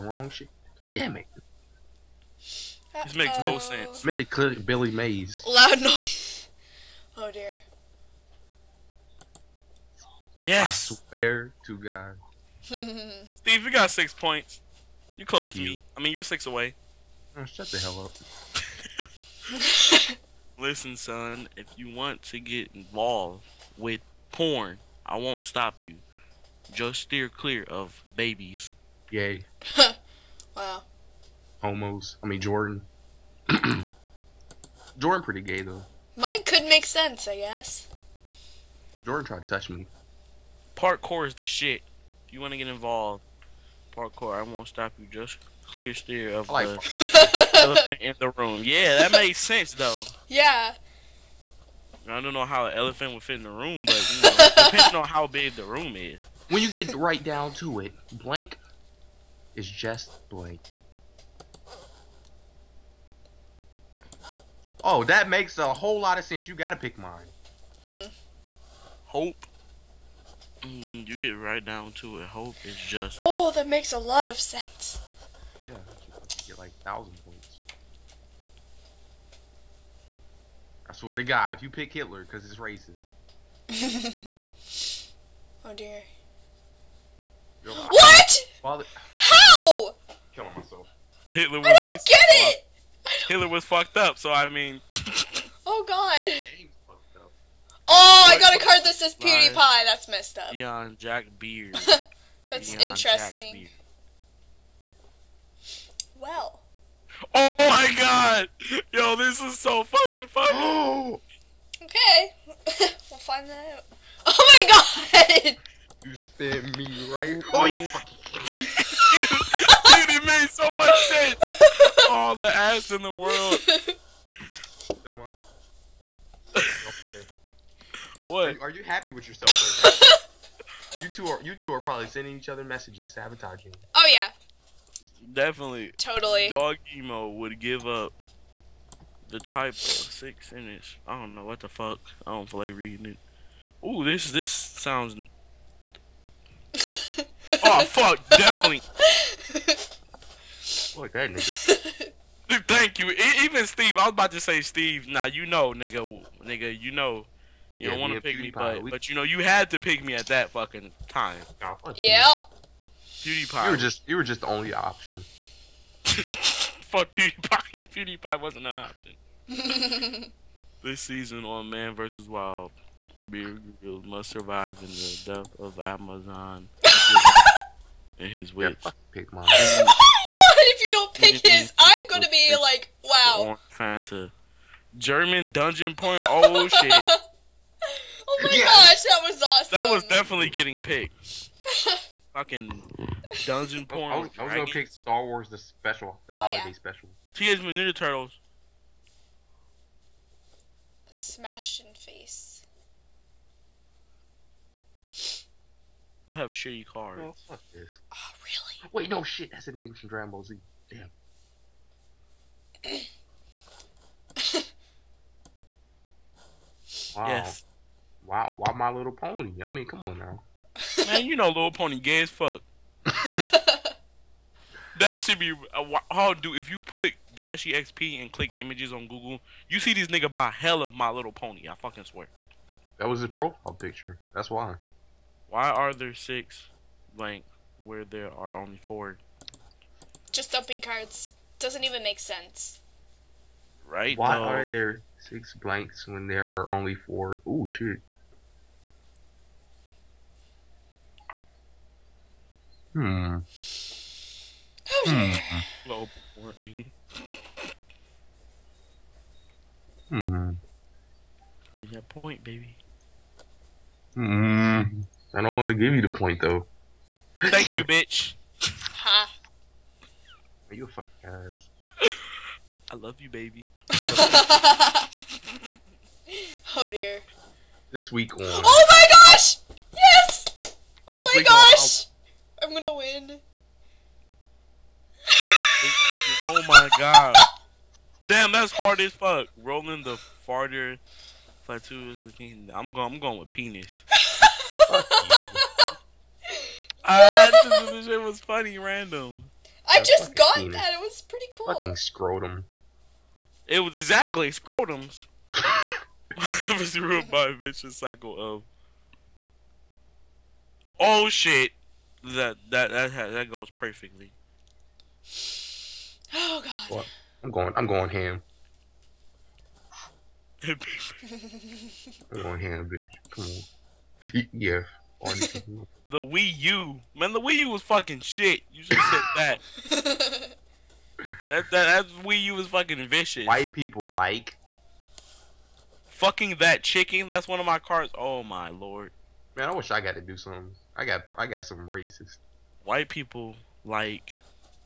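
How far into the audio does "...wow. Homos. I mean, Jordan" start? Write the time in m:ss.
0:30.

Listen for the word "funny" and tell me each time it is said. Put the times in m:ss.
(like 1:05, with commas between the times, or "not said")
1:50, 4:58.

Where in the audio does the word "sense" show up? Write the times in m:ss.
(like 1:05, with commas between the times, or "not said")
0:03, 0:36, 0:49, 1:06, 1:14, 2:01, 4:02.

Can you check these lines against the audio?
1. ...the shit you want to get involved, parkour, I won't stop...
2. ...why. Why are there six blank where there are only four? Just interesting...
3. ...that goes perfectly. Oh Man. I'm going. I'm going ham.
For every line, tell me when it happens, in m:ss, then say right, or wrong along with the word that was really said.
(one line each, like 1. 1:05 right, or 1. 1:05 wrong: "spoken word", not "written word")
1. 0:41 right
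2. 3:54 wrong: "dumping", not "interesting"
3. 5:13 wrong: "God", not "Man".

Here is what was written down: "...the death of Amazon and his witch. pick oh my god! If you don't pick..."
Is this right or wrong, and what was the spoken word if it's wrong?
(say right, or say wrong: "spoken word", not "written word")
right.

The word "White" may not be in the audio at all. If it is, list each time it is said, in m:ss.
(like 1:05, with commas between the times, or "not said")
5:33, 5:42.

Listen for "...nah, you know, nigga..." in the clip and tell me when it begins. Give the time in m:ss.
2:35.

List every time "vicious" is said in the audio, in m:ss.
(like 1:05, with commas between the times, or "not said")
5:07, 5:33.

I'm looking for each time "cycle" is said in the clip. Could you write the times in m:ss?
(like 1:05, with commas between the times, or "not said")
5:07.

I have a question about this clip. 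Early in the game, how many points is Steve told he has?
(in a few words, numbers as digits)
6.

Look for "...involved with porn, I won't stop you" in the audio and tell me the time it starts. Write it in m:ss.
0:22.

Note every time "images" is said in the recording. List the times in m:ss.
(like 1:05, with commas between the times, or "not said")
3:48.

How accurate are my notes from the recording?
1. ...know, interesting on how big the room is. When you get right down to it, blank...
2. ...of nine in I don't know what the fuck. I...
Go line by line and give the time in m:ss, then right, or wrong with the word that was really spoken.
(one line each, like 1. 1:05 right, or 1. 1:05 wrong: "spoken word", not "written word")
1. 0:54 wrong: "depending", not "interesting"
2. 2:19 wrong: "six", not "nine".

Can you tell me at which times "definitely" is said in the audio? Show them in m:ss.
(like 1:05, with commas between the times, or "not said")
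2:15, 2:28, 3:10.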